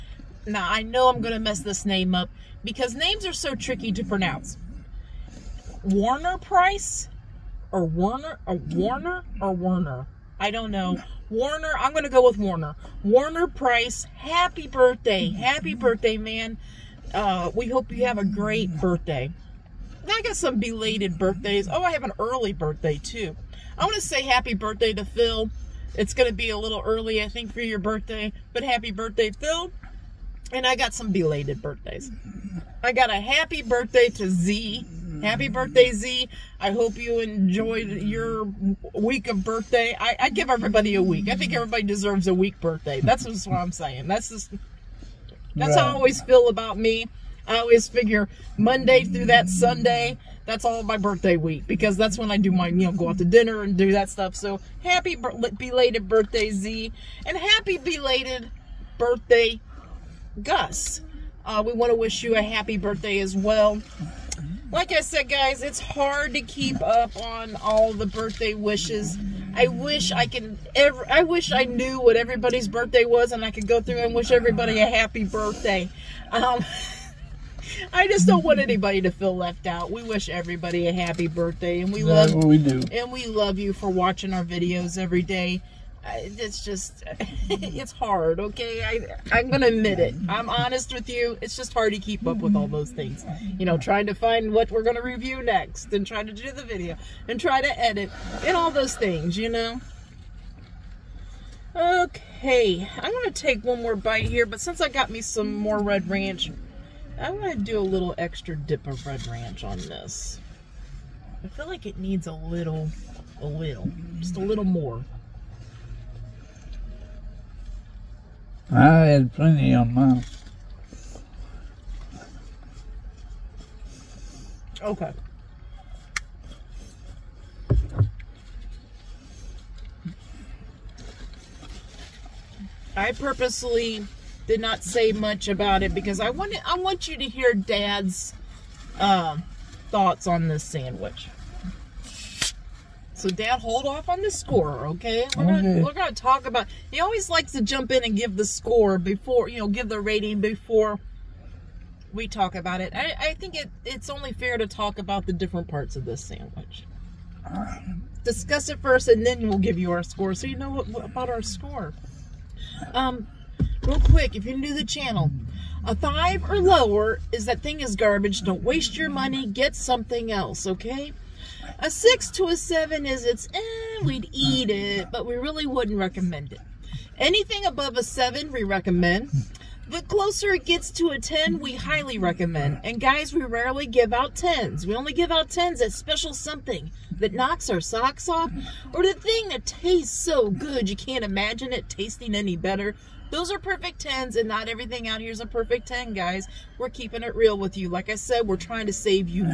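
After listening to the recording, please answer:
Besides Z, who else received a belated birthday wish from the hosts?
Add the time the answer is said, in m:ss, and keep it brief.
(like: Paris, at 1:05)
Gus, at 1:00.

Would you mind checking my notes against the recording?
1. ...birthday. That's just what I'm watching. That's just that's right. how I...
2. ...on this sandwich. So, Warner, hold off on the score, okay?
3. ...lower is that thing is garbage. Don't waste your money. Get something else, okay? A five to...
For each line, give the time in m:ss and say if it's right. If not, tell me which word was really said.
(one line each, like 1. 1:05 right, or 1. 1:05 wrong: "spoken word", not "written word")
1. 0:42 wrong: "saying", not "watching"
2. 2:20 wrong: "Dad", not "Warner"
3. 2:46 wrong: "six", not "five".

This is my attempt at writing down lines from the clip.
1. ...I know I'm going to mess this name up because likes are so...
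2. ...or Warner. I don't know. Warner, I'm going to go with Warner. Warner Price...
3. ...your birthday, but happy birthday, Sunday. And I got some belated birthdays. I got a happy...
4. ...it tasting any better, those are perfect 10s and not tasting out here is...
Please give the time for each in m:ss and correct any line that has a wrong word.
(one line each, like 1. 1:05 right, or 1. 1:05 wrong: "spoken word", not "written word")
1. 0:00 wrong: "names", not "likes"
2. 0:09 right
3. 0:27 wrong: "Phil", not "Sunday"
4. 3:11 wrong: "everything", not "tasting".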